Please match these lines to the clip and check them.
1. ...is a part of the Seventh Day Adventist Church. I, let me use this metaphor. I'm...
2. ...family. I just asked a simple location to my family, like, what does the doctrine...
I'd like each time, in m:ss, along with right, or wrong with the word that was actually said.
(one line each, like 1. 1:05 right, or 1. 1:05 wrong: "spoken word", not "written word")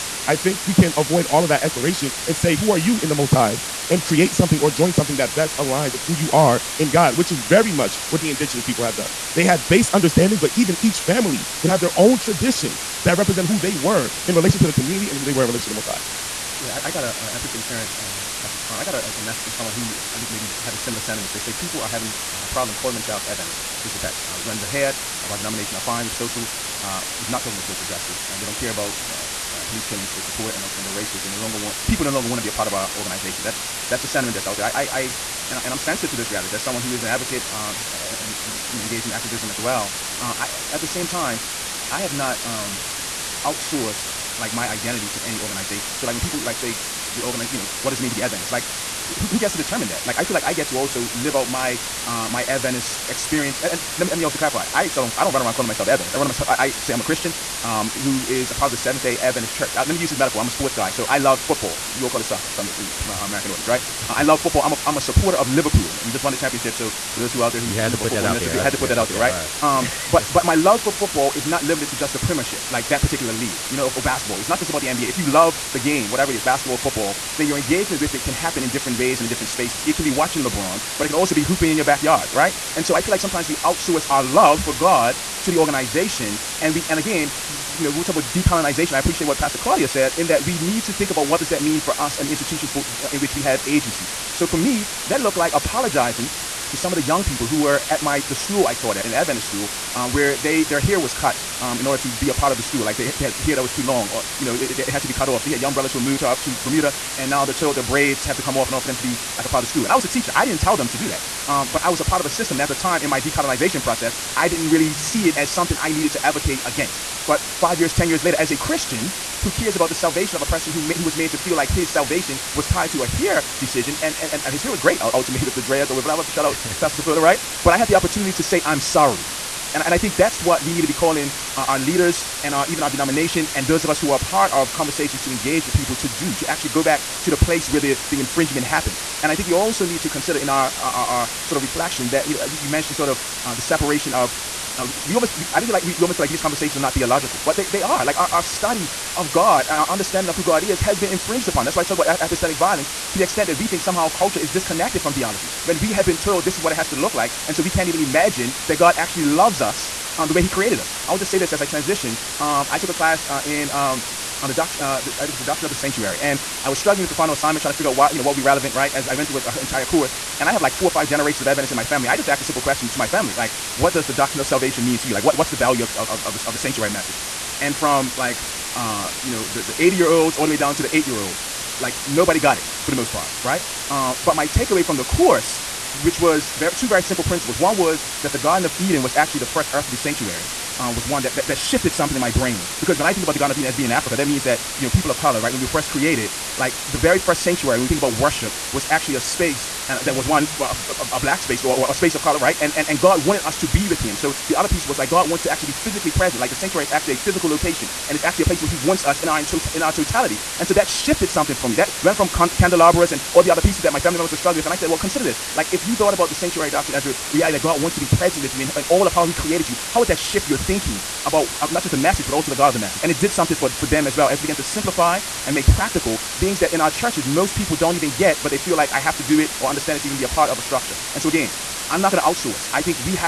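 1. 0:58 right
2. 2:51 wrong: "question", not "location".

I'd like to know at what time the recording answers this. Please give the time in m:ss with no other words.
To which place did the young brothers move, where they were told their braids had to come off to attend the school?
1:46.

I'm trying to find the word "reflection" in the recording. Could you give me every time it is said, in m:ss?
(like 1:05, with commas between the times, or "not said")
2:21.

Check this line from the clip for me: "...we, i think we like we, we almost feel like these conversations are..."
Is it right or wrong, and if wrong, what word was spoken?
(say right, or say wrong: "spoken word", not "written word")
right.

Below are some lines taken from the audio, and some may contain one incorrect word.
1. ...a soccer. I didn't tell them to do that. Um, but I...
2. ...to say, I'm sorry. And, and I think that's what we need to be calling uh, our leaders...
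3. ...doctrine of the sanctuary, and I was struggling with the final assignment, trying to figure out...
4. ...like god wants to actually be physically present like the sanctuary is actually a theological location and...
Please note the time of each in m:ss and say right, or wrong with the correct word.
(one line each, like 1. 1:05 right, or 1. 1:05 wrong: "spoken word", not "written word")
1. 1:50 wrong: "teacher", not "soccer"
2. 2:08 right
3. 2:45 right
4. 3:24 wrong: "physical", not "theological".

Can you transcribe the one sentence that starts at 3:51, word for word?
And so, again, I'm not going to outsource.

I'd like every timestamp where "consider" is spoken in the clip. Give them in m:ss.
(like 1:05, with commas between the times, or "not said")
2:20, 3:34.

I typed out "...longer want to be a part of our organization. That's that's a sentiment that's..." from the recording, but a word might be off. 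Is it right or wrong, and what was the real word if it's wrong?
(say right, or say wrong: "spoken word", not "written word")
right.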